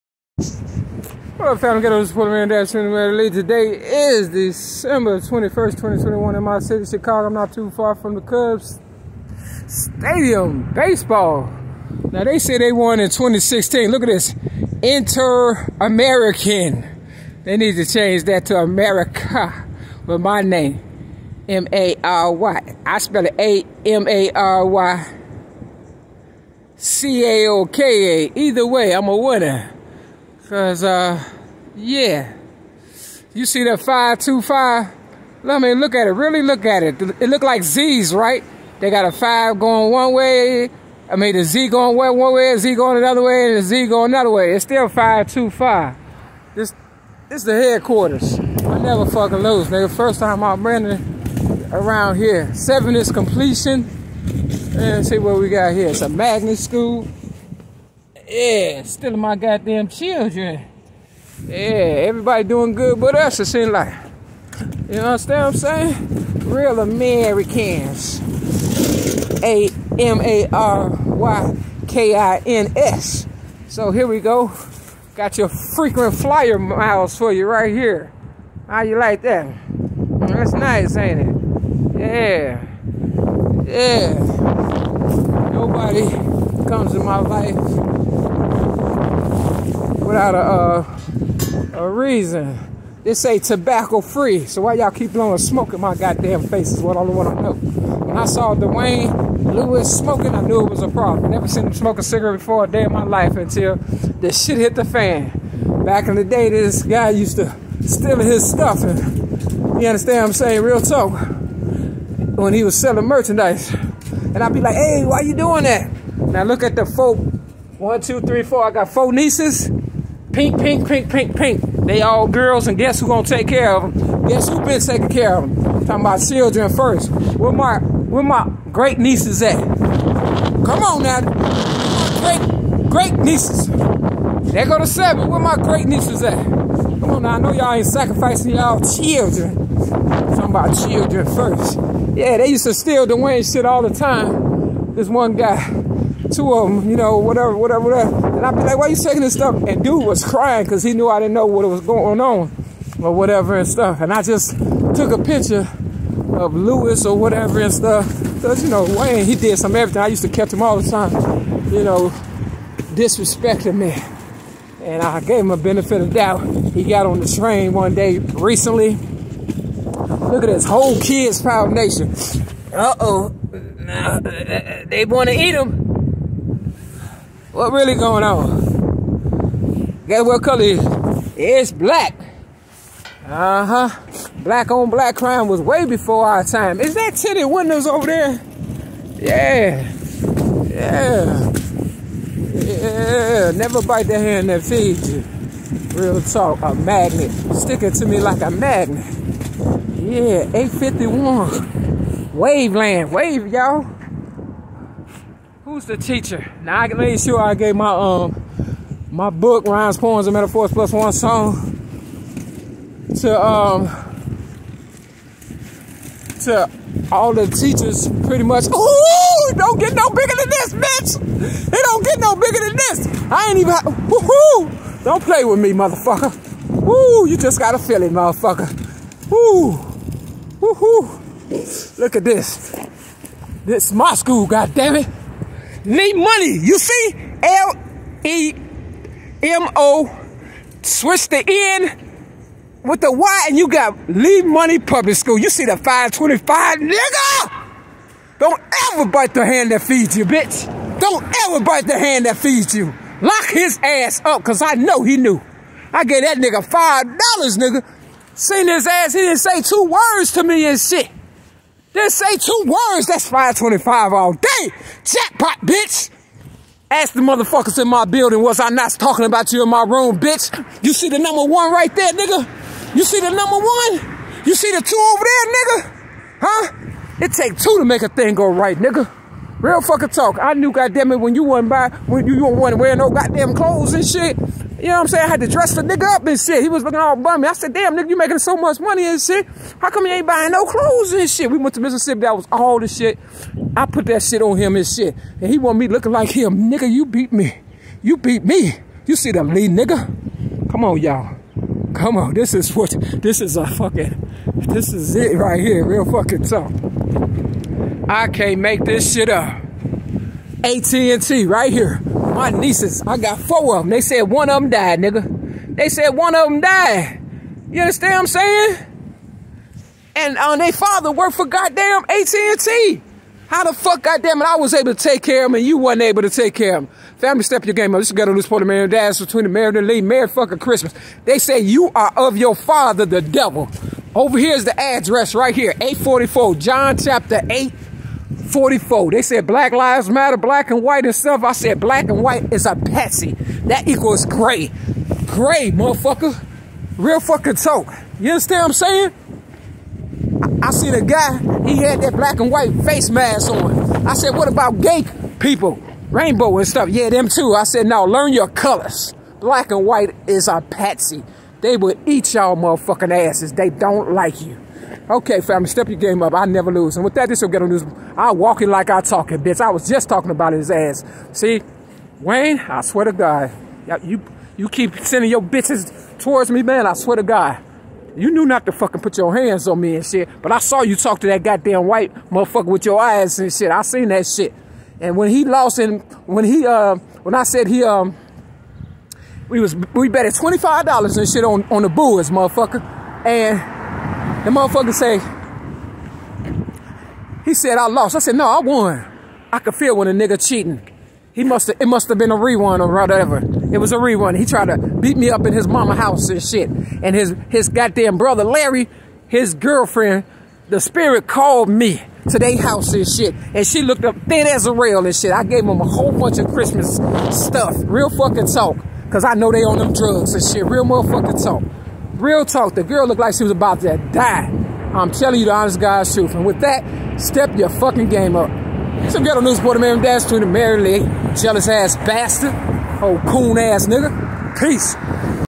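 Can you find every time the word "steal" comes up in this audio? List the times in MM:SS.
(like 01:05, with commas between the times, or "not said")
01:47, 02:22.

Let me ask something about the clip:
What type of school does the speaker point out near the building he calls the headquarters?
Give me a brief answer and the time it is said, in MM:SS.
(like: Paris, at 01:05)
magnet school, at 00:56.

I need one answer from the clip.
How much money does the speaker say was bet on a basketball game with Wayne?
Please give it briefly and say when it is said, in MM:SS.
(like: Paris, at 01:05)
$25, at 06:30.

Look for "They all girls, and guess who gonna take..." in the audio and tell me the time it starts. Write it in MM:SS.
02:01.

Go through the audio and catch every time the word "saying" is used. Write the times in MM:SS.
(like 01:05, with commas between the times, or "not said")
01:05, 01:50, 04:45, 05:18, 05:48.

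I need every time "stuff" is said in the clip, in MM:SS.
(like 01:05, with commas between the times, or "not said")
01:48, 02:29, 02:33, 02:37, 05:41, 05:56, 06:57.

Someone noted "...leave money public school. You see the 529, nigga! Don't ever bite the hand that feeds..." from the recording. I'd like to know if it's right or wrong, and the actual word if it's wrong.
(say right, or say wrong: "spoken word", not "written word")
wrong: "525", not "529".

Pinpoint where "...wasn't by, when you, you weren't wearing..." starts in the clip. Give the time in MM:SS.
04:41.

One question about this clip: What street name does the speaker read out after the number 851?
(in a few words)
Waveland.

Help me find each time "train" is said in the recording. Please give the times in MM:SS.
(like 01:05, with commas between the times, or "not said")
02:47.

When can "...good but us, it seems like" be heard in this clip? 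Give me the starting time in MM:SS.
01:02.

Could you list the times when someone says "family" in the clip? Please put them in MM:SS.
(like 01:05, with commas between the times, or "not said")
05:27, 06:05.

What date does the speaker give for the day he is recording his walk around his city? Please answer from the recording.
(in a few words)
December 21st, 2021.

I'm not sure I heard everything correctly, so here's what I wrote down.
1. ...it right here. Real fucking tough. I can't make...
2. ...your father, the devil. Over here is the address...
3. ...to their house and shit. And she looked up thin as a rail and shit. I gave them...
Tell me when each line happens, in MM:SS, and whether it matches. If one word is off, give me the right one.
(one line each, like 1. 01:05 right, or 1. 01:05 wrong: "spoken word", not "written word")
1. 05:05 right
2. 05:32 right
3. 06:52 right.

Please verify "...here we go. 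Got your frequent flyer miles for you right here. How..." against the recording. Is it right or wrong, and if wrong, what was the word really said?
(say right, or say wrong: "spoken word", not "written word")
right.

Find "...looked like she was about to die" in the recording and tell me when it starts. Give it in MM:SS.
07:03.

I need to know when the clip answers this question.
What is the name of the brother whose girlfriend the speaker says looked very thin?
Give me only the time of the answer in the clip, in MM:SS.
06:48.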